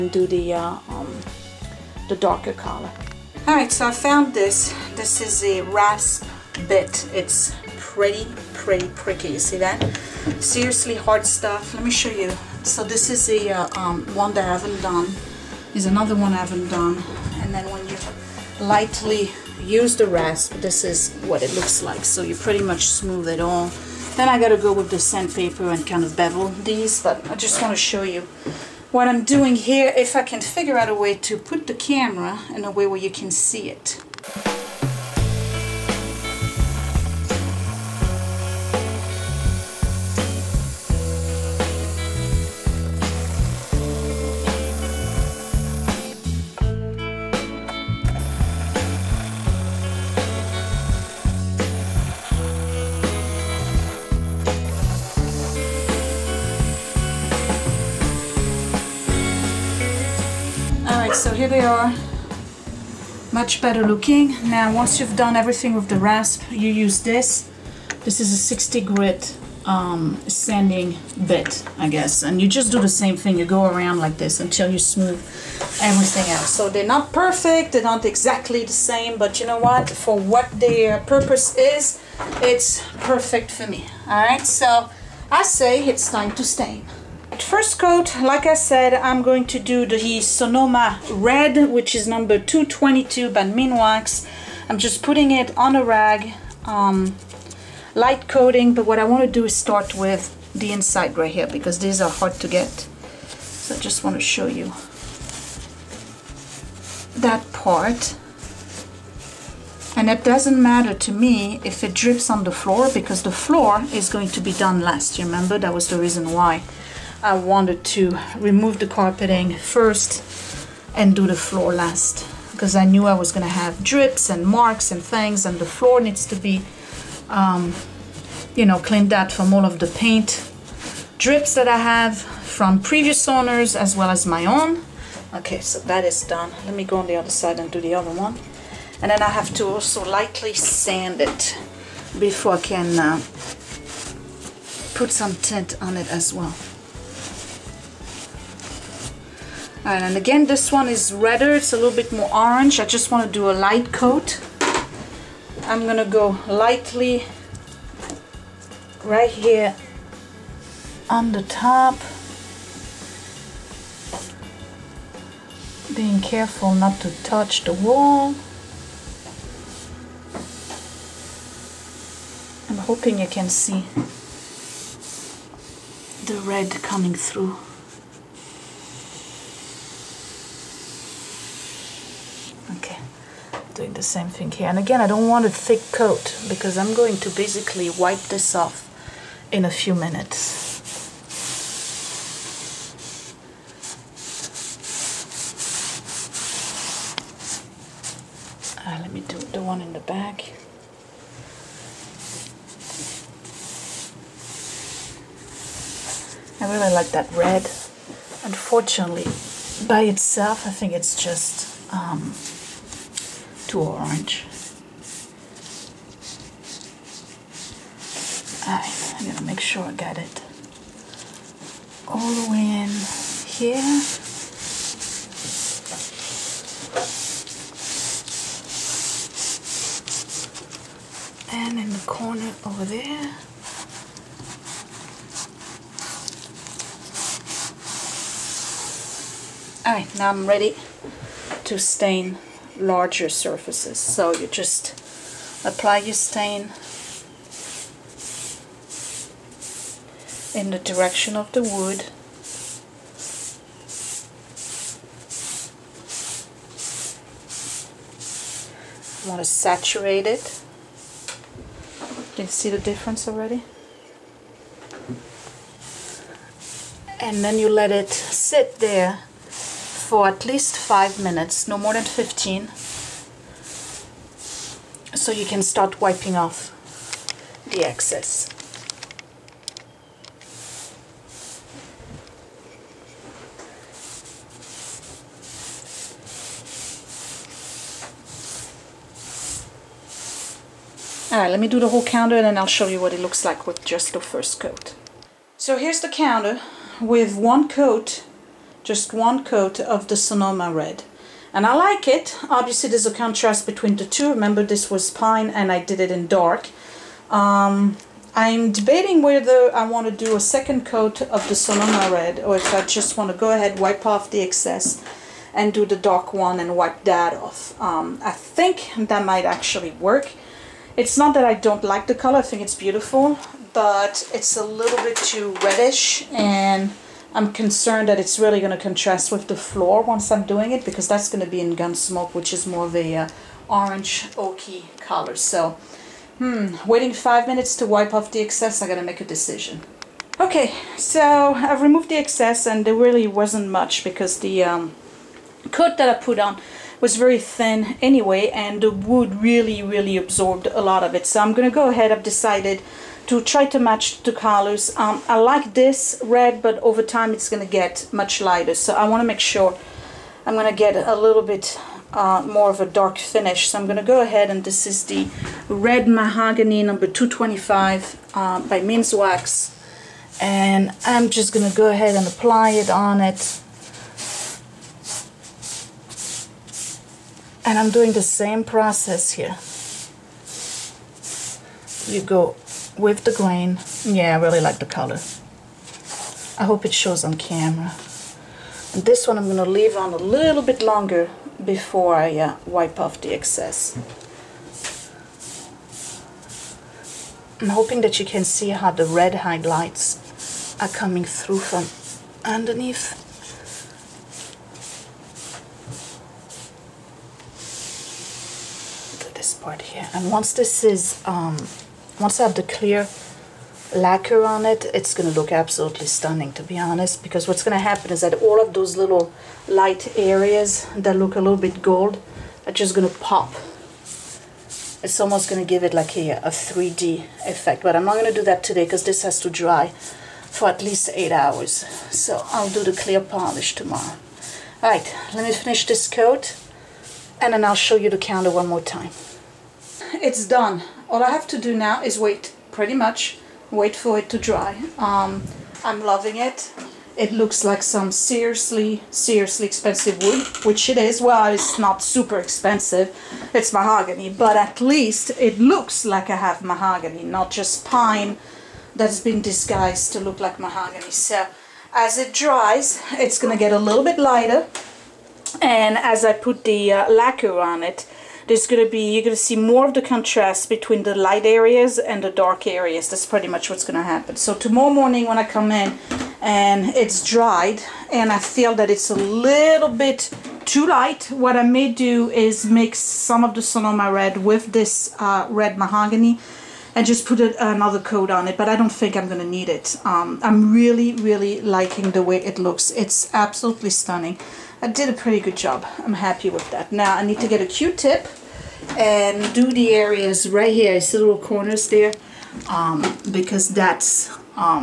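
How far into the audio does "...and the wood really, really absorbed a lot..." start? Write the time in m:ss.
5:48.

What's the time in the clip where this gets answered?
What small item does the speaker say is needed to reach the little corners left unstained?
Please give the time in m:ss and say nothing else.
8:17.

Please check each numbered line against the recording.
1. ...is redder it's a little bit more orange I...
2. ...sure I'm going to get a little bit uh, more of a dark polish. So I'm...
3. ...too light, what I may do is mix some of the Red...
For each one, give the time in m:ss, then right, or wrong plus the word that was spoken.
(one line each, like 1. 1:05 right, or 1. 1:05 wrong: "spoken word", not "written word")
1. 2:30 right
2. 5:59 wrong: "finish", not "polish"
3. 8:00 wrong: "Sonoma", not "Red".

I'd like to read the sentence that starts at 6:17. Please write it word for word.
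And I'm doing the same process here.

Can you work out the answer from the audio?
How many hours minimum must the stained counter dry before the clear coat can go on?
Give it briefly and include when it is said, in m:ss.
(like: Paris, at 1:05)
8, at 7:11.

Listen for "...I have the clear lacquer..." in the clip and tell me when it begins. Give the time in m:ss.
6:52.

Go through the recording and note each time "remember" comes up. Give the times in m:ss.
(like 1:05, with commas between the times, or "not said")
1:55, 5:04.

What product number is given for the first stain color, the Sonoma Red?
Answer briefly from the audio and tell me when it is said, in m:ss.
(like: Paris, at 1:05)
222, at 1:32.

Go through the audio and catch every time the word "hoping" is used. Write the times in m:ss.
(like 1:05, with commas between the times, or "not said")
2:52, 6:37.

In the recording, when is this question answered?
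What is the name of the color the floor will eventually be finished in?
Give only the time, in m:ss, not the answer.
5:31.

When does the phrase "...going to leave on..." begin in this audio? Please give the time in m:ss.
6:29.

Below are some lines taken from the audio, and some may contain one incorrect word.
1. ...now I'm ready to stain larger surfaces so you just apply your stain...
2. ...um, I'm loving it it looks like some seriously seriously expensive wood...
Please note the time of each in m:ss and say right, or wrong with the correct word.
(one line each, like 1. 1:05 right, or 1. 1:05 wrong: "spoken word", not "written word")
1. 4:00 right
2. 7:24 right.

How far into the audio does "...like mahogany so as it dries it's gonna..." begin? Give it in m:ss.
7:40.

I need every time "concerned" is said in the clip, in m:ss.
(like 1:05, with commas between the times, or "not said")
5:27.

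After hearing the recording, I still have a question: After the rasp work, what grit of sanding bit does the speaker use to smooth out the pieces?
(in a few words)
60.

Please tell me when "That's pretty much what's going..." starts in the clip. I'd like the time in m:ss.
7:53.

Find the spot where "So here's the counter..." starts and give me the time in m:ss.
4:55.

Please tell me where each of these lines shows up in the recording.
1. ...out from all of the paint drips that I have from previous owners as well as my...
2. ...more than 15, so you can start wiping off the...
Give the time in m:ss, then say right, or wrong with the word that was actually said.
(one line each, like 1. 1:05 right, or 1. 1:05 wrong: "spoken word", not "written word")
1. 2:09 right
2. 4:31 right.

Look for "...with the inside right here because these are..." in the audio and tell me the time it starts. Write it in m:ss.
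1:39.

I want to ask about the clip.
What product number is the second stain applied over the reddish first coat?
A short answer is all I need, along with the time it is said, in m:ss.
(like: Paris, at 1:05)
225, at 6:07.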